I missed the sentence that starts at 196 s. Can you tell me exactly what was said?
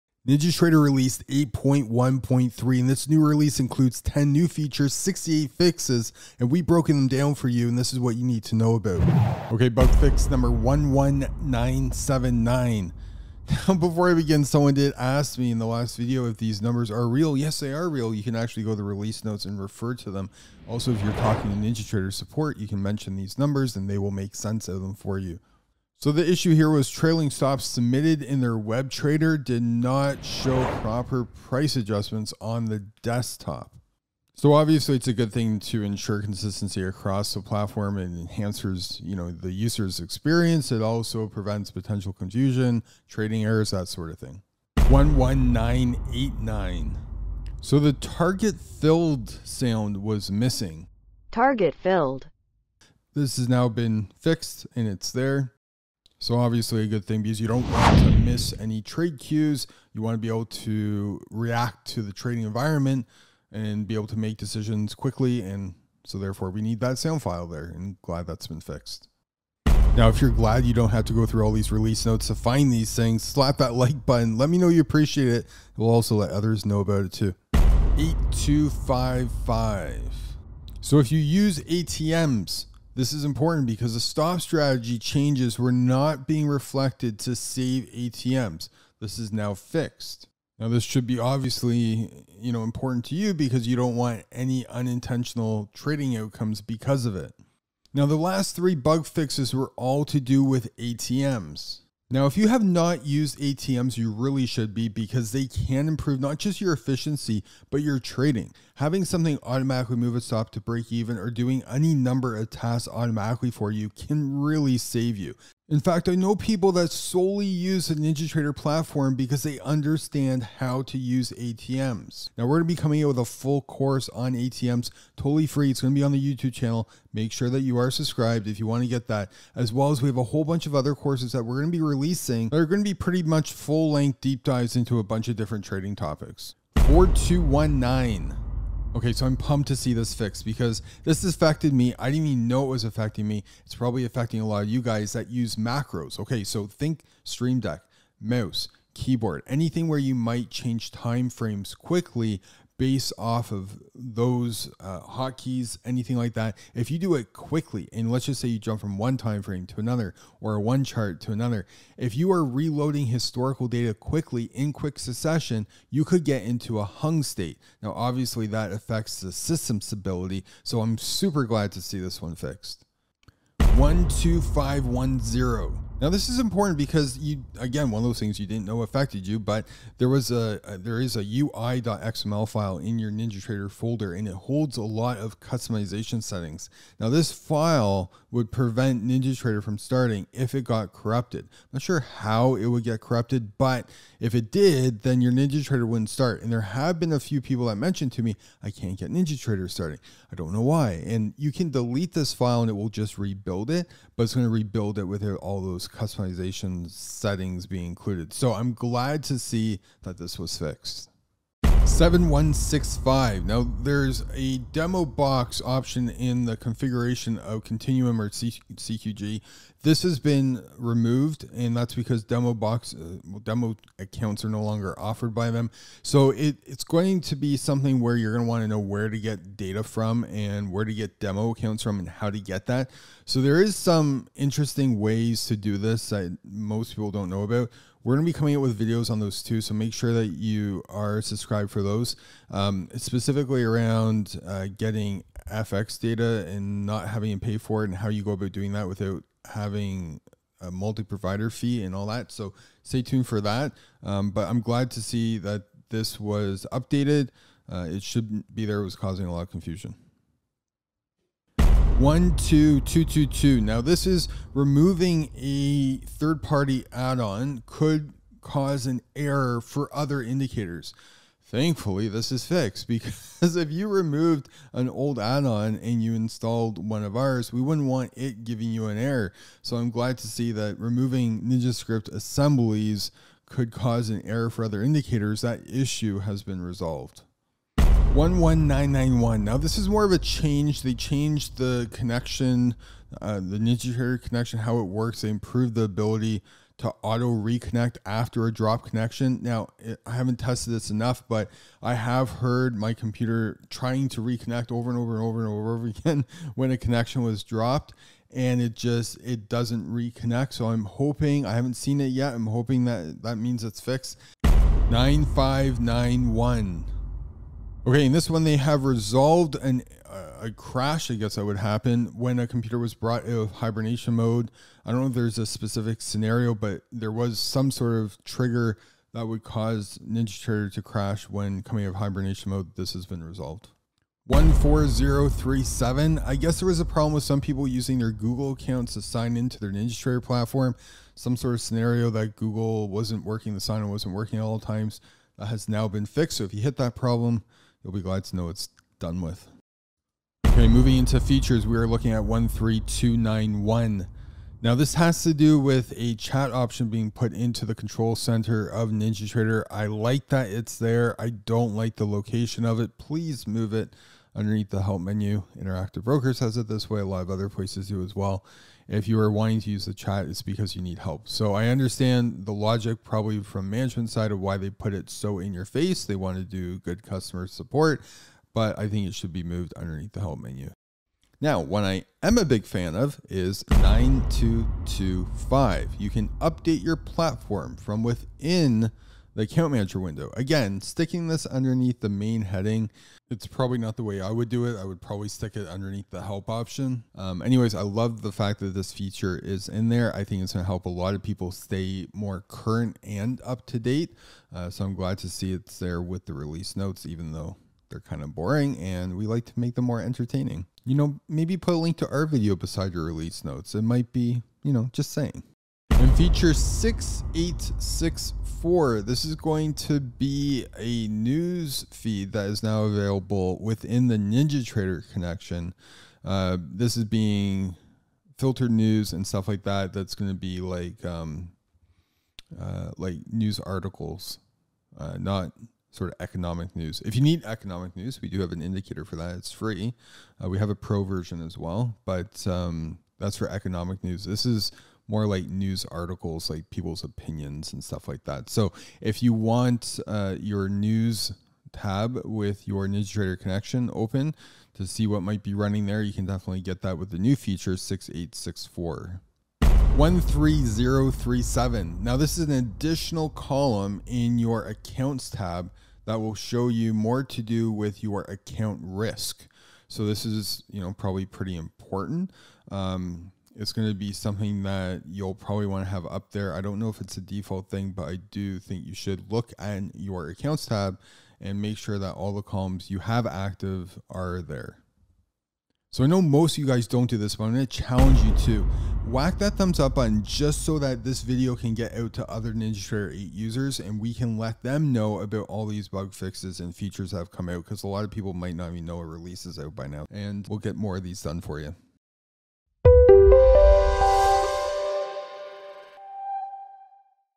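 And there have been a few people that mentioned to me, I can't get NinjaTrader starting.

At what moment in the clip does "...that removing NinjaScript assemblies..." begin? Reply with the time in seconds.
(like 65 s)
280 s.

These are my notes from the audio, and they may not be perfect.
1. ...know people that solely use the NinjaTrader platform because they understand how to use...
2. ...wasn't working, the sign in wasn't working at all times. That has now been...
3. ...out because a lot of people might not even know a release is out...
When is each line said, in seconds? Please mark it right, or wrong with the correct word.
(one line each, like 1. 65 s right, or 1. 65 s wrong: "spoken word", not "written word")
1. 116 s right
2. 342 s right
3. 497 s right.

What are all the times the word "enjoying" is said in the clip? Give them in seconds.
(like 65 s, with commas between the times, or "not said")
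not said.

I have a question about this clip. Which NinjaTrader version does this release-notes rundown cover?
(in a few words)
8.1.3.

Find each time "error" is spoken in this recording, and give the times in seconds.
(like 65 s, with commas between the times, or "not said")
43 s, 269 s, 278 s, 284 s.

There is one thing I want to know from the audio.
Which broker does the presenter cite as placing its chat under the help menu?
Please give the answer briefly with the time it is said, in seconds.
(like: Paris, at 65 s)
Interactive Brokers, at 365 s.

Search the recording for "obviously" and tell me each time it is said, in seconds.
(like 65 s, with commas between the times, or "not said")
34 s, 56 s, 91 s, 167 s.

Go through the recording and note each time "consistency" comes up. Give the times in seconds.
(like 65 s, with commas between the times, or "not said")
36 s.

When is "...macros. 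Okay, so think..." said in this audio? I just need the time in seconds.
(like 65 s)
145 s.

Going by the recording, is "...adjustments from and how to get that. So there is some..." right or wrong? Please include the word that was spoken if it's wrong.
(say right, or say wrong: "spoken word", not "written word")
wrong: "accounts", not "adjustments".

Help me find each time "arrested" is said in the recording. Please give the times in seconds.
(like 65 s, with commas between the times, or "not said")
not said.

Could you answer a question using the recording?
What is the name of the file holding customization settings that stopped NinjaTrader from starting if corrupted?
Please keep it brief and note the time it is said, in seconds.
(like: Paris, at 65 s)
UI.xml, at 181 s.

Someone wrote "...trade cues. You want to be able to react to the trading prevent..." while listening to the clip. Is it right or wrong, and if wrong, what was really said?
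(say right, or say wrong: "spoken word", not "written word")
wrong: "environment", not "prevent".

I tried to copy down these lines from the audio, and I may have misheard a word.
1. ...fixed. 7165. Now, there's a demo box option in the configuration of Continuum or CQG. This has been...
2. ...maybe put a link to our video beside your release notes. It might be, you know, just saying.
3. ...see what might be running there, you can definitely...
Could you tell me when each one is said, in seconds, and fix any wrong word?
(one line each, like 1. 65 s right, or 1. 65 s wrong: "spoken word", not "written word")
1. 210 s right
2. 411 s right
3. 454 s right.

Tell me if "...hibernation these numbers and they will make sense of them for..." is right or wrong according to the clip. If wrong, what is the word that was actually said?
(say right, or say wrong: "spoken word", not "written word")
wrong: "mention", not "hibernation".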